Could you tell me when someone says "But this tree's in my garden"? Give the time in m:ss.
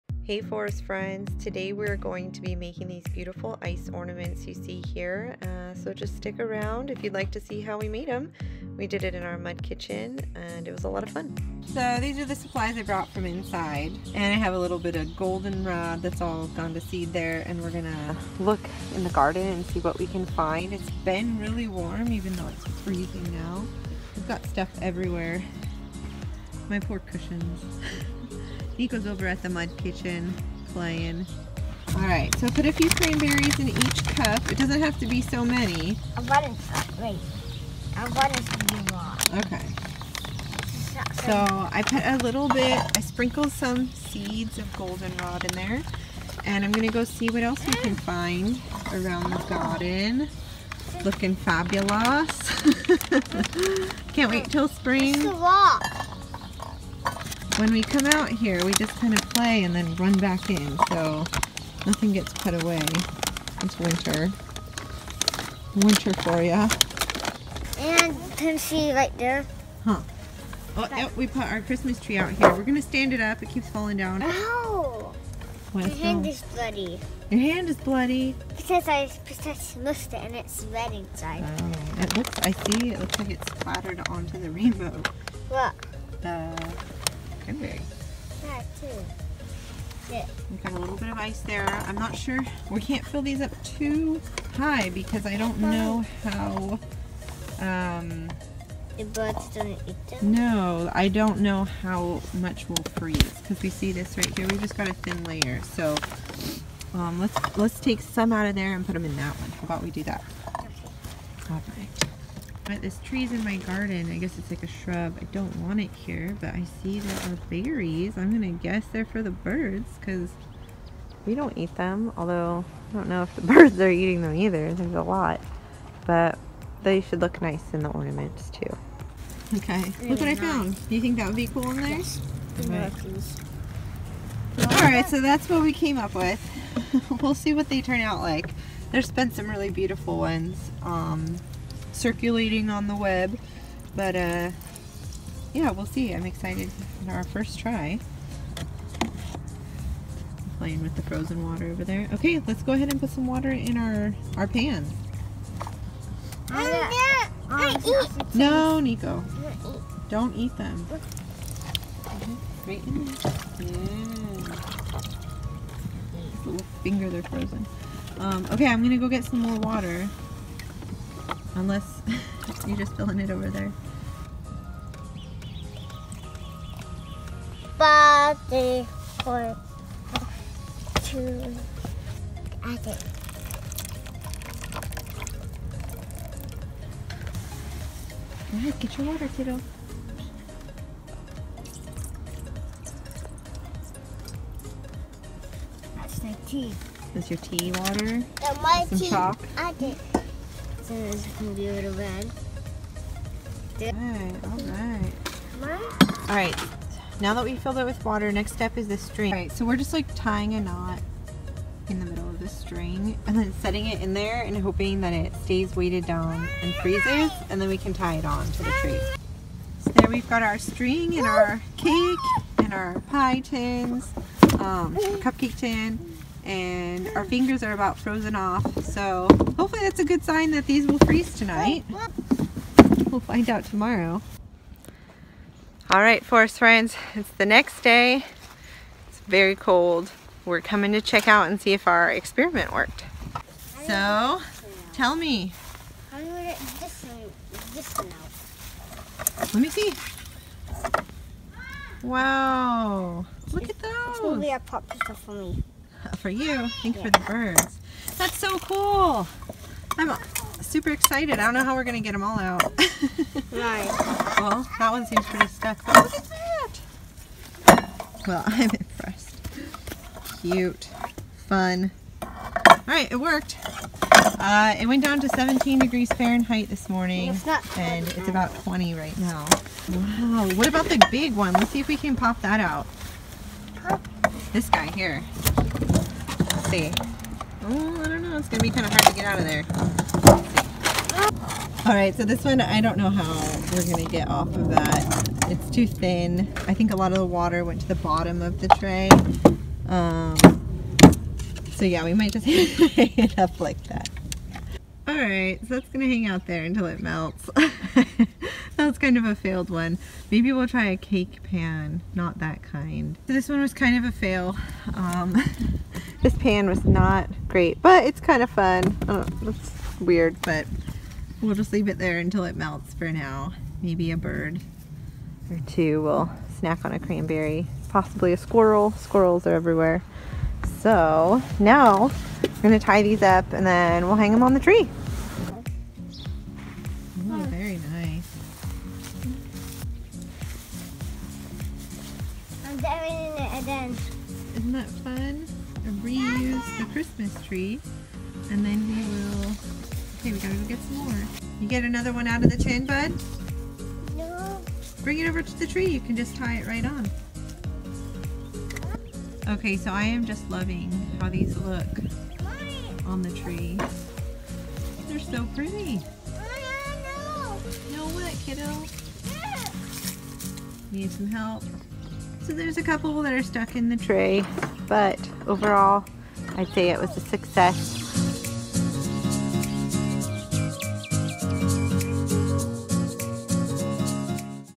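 1:52.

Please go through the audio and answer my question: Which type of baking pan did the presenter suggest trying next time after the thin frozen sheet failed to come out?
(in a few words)
A cake pan.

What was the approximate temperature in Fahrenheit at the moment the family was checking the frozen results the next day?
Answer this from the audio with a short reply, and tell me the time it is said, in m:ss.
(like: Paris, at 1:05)
20, at 4:38.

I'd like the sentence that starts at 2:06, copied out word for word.
But they should look nice in the ornaments too.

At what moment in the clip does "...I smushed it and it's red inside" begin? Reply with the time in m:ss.
1:18.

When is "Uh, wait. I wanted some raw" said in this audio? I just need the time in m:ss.
0:36.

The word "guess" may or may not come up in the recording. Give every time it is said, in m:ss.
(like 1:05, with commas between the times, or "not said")
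1:54, 1:58.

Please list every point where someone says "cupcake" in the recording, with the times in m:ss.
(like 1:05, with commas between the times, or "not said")
3:45.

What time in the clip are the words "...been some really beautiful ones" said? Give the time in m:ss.
2:19.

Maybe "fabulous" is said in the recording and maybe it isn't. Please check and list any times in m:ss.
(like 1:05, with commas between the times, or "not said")
0:51.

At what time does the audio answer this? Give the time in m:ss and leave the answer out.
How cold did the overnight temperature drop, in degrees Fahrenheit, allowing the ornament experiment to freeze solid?
4:35.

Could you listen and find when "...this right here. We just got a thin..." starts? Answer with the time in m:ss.
1:43.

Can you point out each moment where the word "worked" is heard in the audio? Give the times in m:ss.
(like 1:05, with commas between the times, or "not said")
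4:02, 4:33.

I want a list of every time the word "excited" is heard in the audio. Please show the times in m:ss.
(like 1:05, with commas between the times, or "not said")
2:26, 4:20.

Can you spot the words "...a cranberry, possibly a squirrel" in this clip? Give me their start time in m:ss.
5:26.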